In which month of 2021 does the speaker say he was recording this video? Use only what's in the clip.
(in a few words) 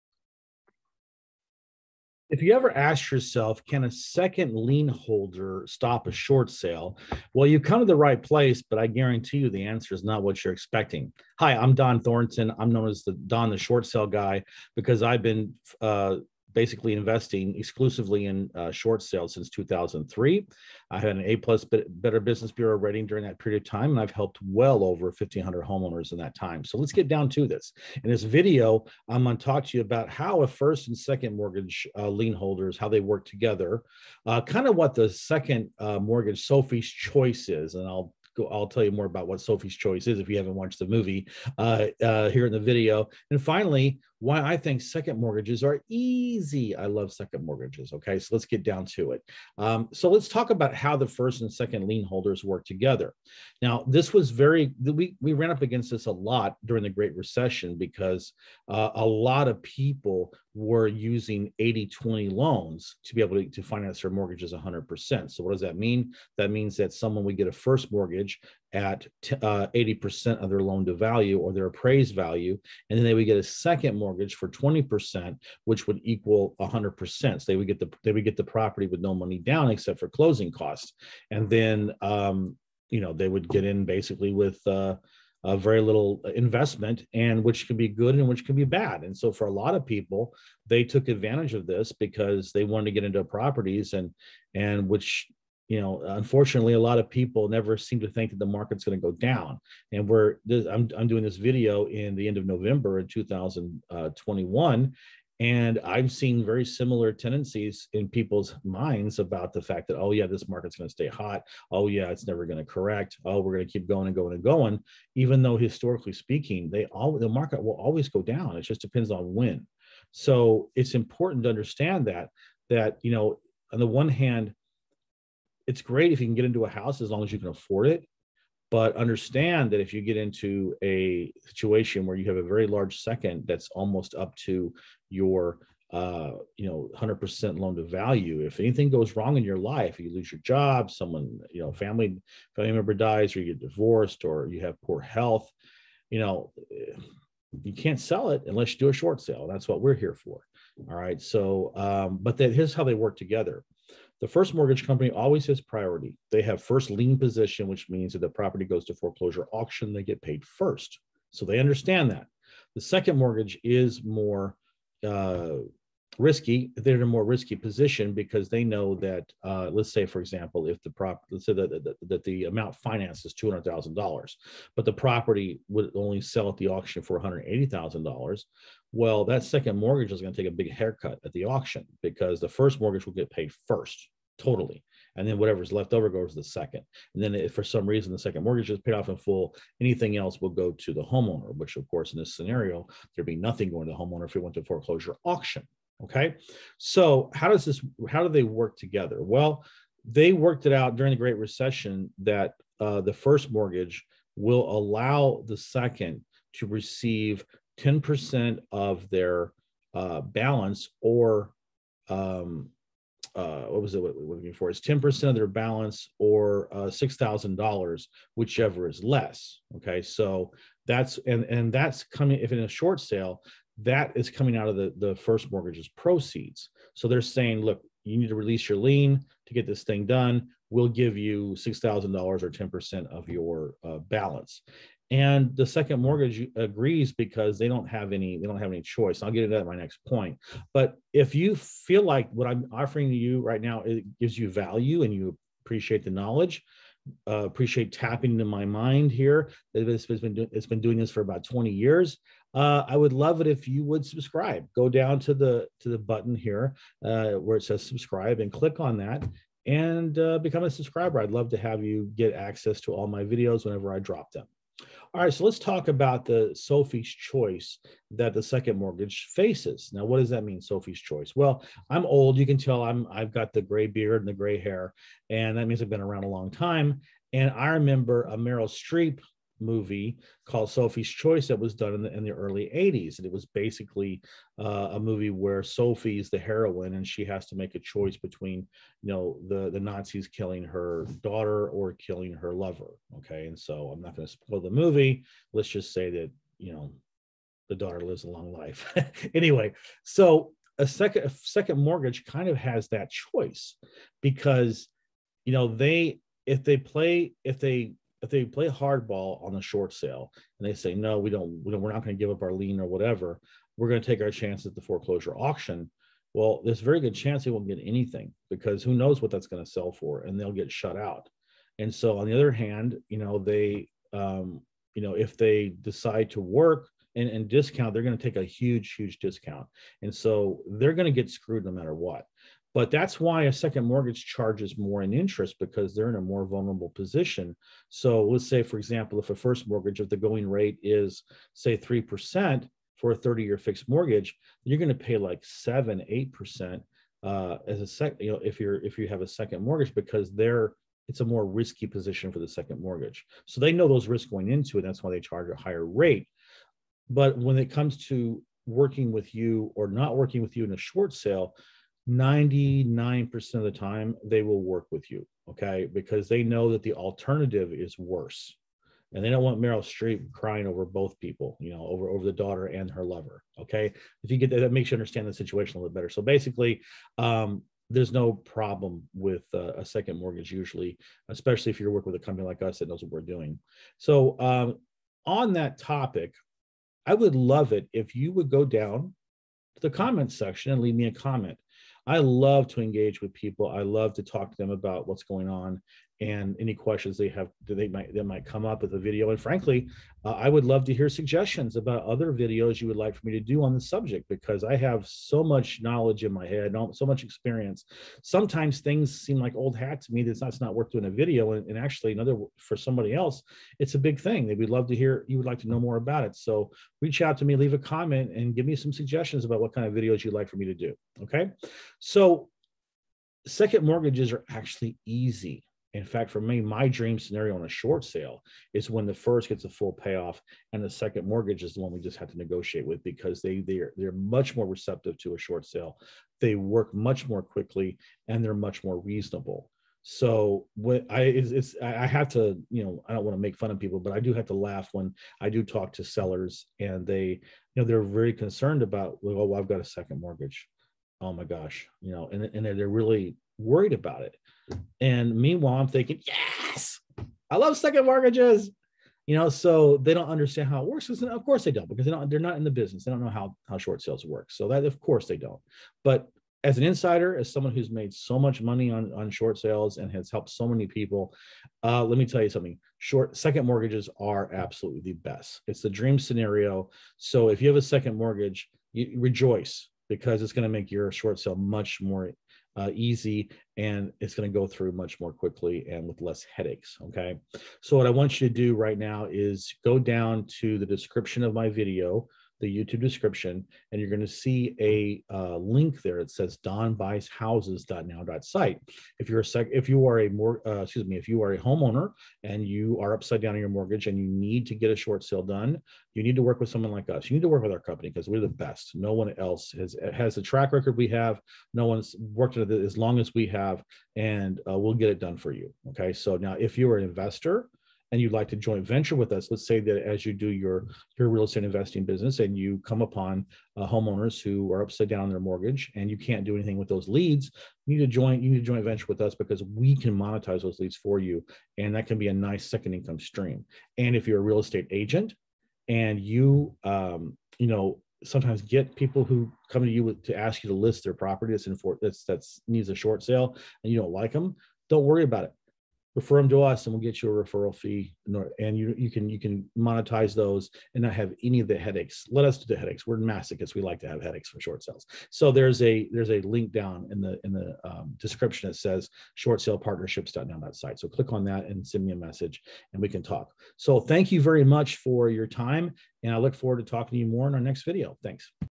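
November.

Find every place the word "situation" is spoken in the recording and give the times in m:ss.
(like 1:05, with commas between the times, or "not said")
2:11, 6:15.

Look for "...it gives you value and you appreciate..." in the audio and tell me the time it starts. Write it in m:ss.
4:03.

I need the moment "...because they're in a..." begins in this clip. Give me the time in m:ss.
5:35.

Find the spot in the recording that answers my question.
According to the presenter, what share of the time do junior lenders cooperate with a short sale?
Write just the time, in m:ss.
6:02.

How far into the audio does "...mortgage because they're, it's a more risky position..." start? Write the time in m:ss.
5:49.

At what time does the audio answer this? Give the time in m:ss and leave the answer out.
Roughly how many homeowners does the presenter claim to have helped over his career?
0:25.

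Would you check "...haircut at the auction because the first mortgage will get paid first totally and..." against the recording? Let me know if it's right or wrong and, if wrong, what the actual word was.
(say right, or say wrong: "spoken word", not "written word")
right.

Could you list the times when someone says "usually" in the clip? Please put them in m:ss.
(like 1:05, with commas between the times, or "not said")
6:20.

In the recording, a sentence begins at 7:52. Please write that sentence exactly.
Short second mortgages are absolutely the best.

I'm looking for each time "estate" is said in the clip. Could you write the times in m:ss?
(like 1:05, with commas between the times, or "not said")
8:41, 8:54.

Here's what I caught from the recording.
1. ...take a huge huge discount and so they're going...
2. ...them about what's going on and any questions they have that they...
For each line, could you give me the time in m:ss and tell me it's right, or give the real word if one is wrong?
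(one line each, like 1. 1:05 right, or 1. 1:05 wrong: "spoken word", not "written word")
1. 5:28 right
2. 6:34 right.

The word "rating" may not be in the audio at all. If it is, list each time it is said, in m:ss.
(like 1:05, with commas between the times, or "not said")
0:22.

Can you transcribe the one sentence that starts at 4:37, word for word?
And I remember a Meryl Streep movie called Sophie's Choice that was done in the, in the early 80s.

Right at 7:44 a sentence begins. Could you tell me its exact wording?
So that of course they don't.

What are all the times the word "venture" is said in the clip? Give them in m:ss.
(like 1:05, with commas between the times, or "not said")
8:38, 8:48.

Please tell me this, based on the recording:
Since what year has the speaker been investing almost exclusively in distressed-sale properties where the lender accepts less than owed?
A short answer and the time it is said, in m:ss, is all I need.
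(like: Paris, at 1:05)
2003, at 0:19.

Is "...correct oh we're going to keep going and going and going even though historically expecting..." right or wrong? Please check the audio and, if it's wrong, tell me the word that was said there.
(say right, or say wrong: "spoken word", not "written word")
wrong: "speaking", not "expecting".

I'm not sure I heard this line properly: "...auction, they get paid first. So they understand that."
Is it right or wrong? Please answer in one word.
right.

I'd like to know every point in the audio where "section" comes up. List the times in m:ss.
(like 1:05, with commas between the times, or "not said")
6:30.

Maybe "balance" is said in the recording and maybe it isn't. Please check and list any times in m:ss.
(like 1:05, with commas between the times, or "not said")
3:30, 3:35, 3:53.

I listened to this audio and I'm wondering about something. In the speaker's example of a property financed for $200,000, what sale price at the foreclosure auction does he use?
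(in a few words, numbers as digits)
$180,000.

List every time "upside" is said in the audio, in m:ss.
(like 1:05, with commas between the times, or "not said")
8:23, 8:44.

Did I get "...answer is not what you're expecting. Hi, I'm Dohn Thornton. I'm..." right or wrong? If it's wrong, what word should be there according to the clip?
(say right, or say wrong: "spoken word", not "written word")
right.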